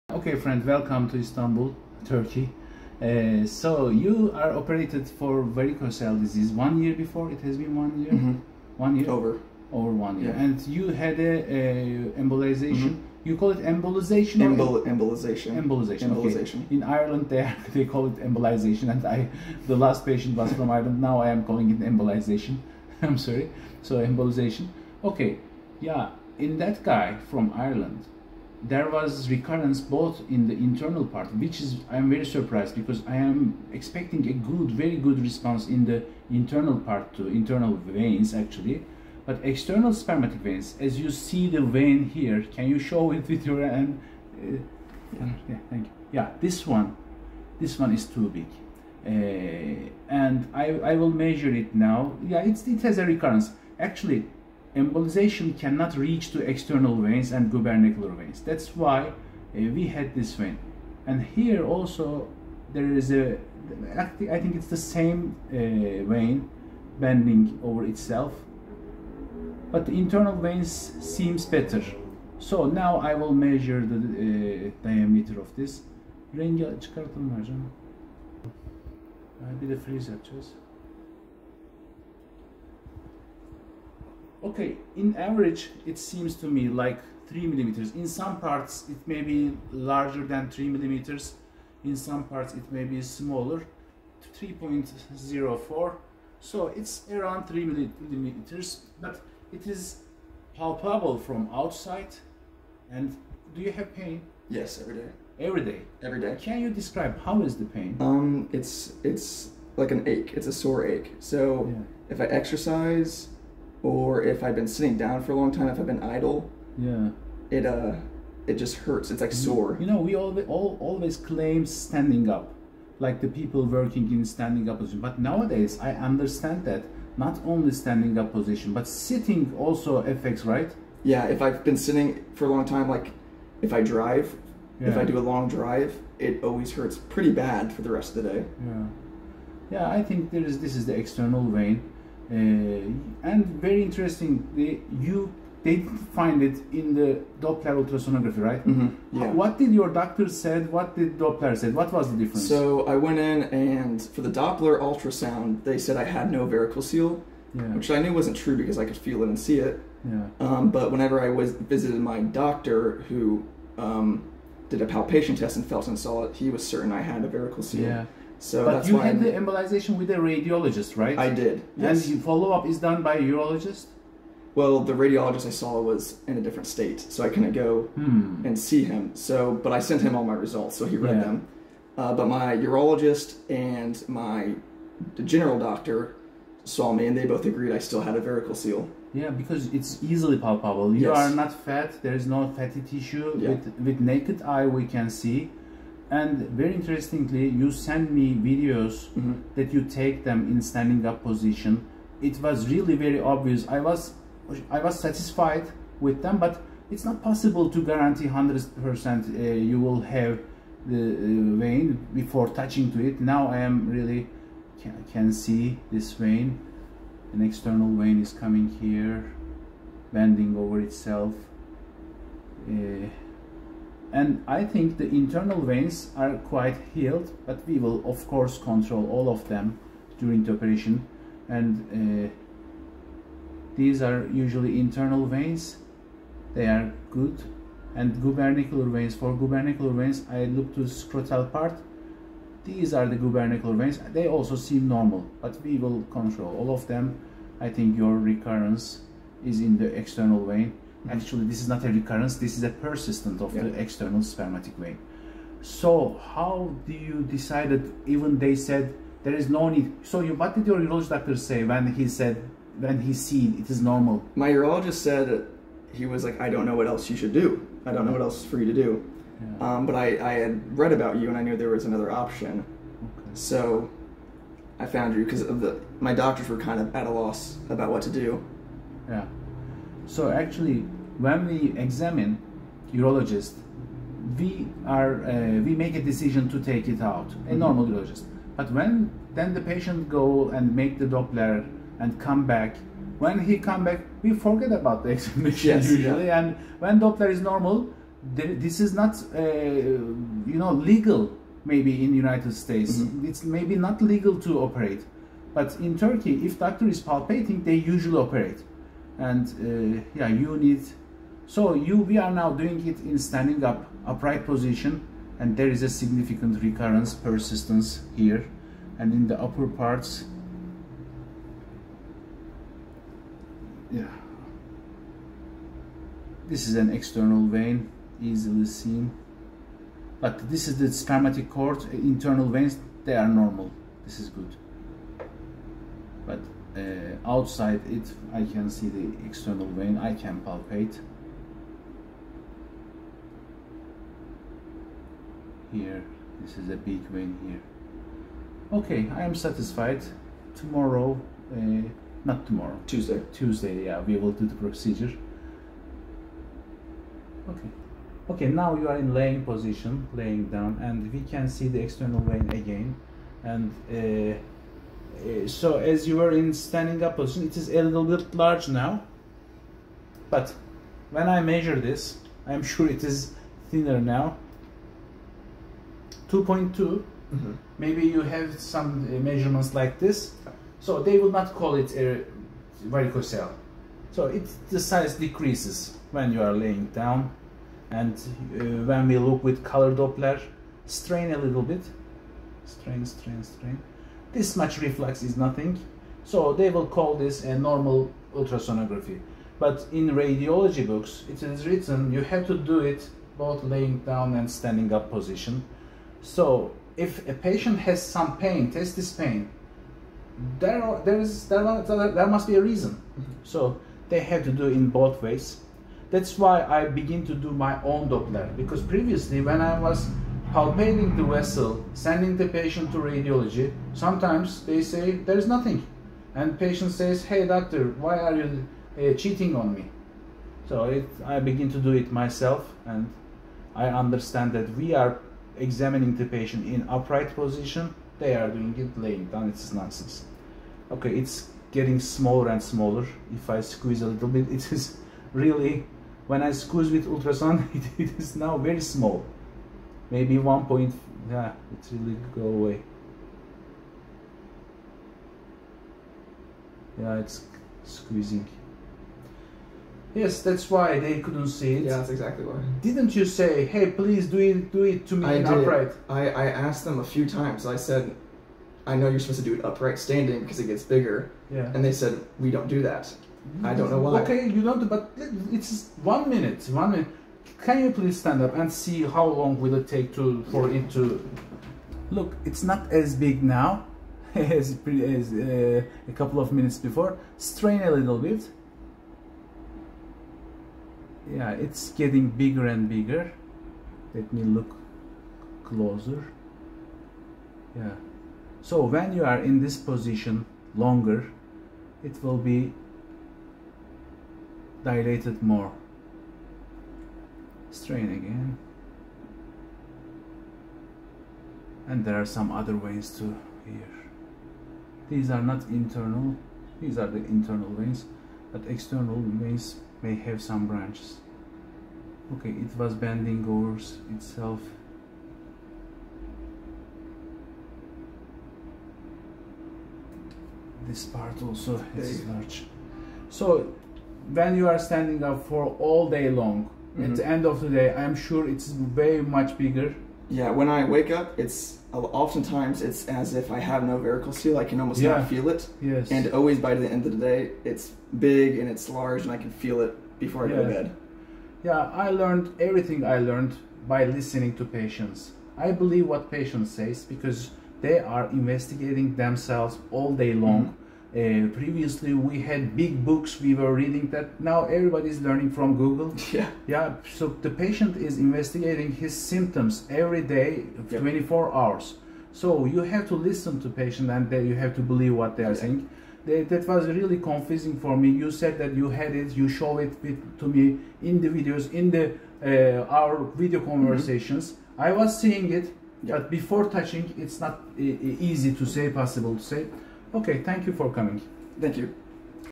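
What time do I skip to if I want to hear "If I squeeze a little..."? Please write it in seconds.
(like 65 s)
443 s.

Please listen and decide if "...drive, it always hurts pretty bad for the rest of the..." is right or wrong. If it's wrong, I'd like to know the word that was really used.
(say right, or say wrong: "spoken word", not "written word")
right.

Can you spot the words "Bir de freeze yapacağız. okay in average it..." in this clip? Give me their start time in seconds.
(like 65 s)
79 s.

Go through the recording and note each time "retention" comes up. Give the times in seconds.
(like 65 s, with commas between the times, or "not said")
not said.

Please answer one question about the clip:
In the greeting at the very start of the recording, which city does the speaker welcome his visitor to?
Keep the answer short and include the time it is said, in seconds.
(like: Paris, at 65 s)
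Istanbul, at 1 s.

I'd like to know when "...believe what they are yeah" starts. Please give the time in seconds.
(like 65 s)
574 s.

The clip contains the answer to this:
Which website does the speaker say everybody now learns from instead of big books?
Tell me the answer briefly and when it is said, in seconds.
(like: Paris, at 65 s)
Google, at 565 s.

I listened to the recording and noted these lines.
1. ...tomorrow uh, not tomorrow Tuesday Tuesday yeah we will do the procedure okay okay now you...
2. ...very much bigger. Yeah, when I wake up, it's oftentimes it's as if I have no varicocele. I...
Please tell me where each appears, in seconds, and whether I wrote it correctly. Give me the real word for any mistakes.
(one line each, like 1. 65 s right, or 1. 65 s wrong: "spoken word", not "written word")
1. 350 s right
2. 538 s right.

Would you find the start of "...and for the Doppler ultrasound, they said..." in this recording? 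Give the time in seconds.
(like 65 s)
153 s.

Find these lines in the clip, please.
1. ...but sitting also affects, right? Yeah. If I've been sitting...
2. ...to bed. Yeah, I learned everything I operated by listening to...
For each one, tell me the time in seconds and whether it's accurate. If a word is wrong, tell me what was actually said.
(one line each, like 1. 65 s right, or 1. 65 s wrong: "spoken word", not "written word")
1. 128 s right
2. 550 s wrong: "learned", not "operated".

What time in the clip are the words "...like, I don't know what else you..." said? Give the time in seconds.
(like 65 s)
266 s.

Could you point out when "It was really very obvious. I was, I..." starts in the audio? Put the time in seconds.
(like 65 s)
202 s.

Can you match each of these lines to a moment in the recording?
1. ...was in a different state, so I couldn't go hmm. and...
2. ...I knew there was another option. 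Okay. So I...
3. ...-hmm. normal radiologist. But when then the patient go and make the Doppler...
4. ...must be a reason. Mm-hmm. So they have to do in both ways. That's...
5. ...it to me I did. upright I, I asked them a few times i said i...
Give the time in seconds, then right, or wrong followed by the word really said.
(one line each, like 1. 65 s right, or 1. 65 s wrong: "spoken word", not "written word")
1. 175 s right
2. 271 s right
3. 287 s wrong: "urologist", not "radiologist"
4. 412 s right
5. 464 s right.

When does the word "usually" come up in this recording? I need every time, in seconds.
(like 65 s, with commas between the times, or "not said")
234 s, 295 s, 307 s.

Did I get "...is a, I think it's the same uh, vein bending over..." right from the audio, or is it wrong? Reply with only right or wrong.
right.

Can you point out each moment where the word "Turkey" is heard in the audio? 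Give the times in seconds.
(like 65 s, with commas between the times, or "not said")
2 s, 305 s.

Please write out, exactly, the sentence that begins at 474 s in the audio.
Okay, you don't, but it's one minute.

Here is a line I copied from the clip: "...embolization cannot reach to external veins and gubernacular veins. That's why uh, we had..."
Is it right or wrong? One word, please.
right.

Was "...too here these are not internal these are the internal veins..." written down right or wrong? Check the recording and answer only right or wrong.
right.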